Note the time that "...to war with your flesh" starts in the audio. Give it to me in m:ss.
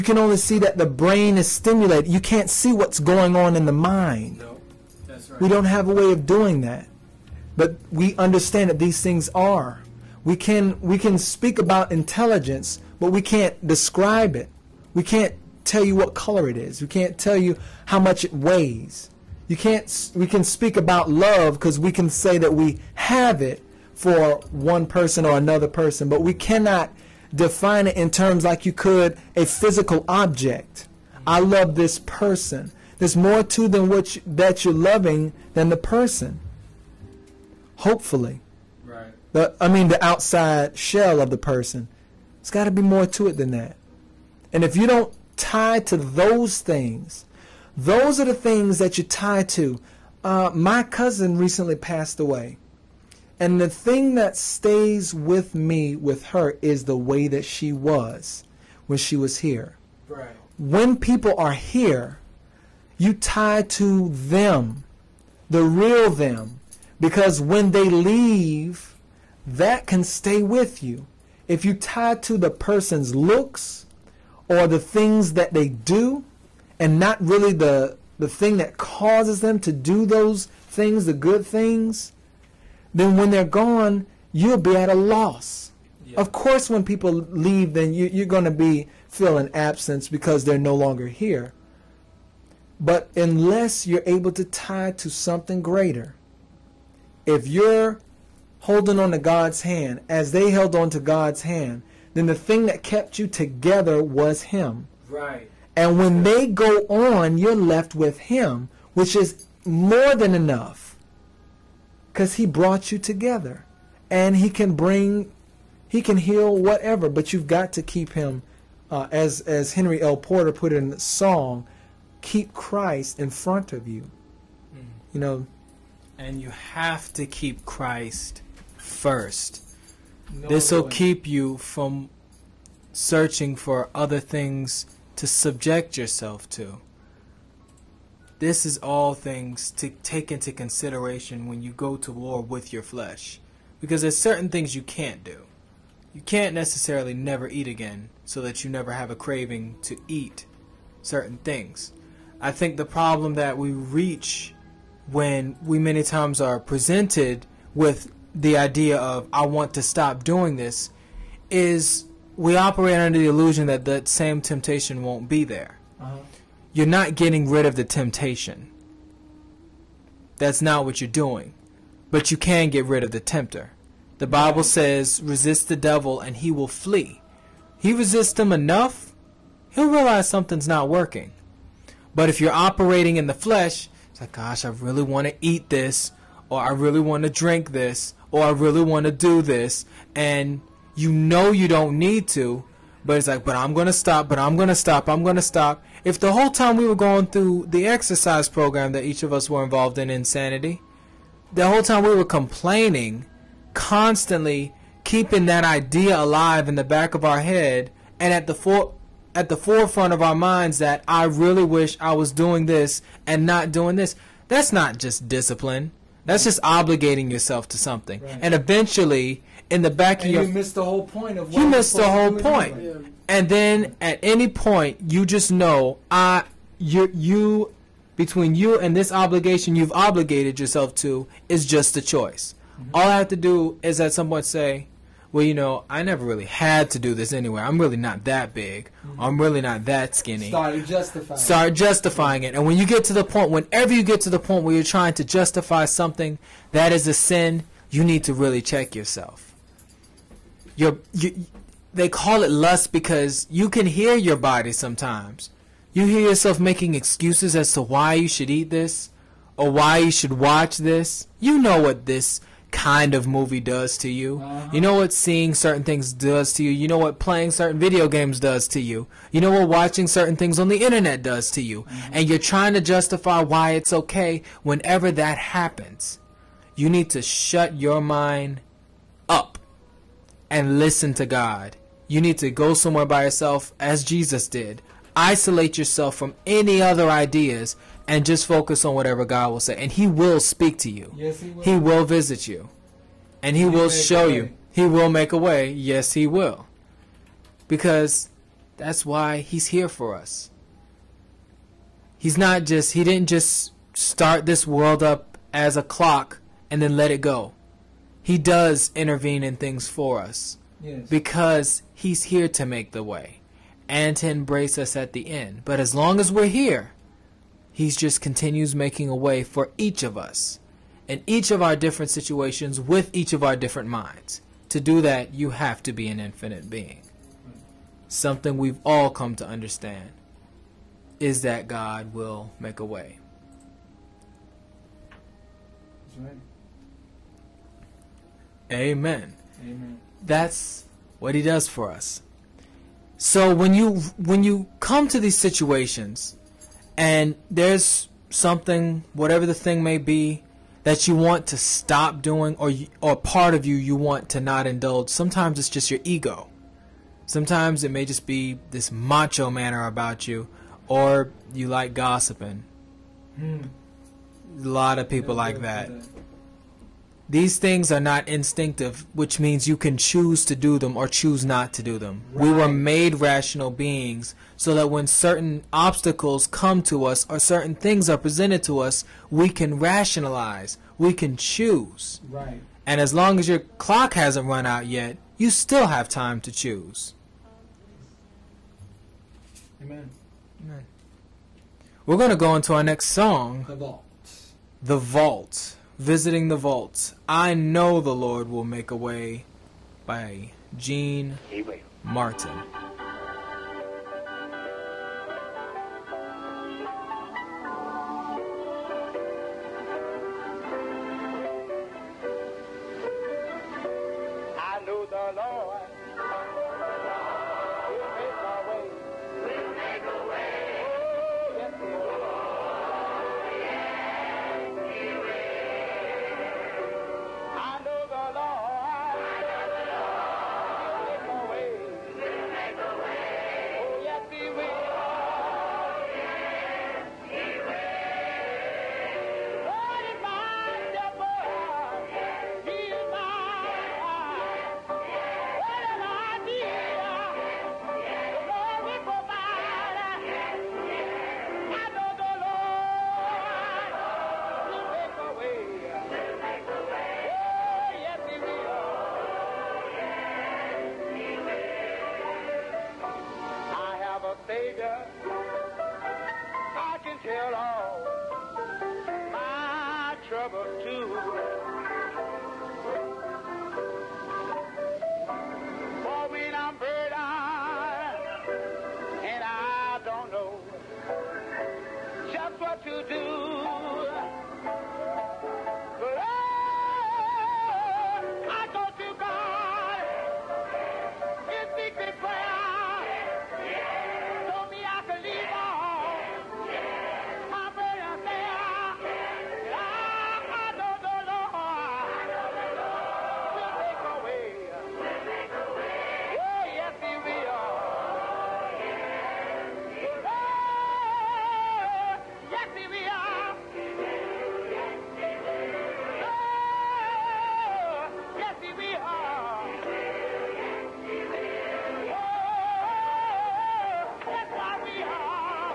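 2:21.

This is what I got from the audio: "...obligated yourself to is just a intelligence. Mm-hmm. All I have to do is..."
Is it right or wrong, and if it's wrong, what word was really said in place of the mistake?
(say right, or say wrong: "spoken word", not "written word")
wrong: "choice", not "intelligence".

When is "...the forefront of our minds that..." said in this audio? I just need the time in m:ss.
3:29.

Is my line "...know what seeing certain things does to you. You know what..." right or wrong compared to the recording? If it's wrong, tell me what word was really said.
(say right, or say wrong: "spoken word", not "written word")
right.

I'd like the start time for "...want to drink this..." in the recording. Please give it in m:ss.
3:06.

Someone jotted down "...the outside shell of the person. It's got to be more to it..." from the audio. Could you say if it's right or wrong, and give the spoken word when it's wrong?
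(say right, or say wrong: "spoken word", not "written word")
right.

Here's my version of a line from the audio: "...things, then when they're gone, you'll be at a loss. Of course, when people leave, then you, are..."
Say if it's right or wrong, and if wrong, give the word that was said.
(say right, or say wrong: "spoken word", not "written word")
right.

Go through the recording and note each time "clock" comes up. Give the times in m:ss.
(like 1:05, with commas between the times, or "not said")
5:05, 6:23.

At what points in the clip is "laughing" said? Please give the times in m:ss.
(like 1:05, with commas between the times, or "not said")
not said.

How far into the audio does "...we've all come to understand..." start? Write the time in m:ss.
5:28.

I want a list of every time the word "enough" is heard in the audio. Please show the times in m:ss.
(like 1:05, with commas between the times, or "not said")
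1:50, 2:58.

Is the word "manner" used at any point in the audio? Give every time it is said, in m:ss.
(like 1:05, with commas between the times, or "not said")
5:59.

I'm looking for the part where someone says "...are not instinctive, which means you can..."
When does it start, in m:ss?
6:07.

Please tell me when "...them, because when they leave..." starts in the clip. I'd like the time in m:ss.
1:06.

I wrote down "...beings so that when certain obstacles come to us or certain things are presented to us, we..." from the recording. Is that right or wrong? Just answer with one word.
right.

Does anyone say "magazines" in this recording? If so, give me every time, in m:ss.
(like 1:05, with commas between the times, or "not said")
not said.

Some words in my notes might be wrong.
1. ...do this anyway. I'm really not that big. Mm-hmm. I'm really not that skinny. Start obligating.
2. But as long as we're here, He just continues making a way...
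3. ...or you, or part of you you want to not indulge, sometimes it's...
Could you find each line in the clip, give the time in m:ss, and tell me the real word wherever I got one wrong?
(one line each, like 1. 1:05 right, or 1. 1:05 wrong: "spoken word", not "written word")
1. 3:56 wrong: "justifying", not "obligating"
2. 5:15 right
3. 5:52 right.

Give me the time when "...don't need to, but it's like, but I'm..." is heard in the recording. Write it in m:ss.
3:11.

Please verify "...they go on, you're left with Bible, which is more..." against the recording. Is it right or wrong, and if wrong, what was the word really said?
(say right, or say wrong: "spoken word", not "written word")
wrong: "Him", not "Bible".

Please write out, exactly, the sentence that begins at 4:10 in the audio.
You're, you they call it lust because you can hear your body sometimes.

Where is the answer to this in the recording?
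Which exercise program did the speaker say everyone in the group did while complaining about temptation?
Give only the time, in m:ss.
3:20.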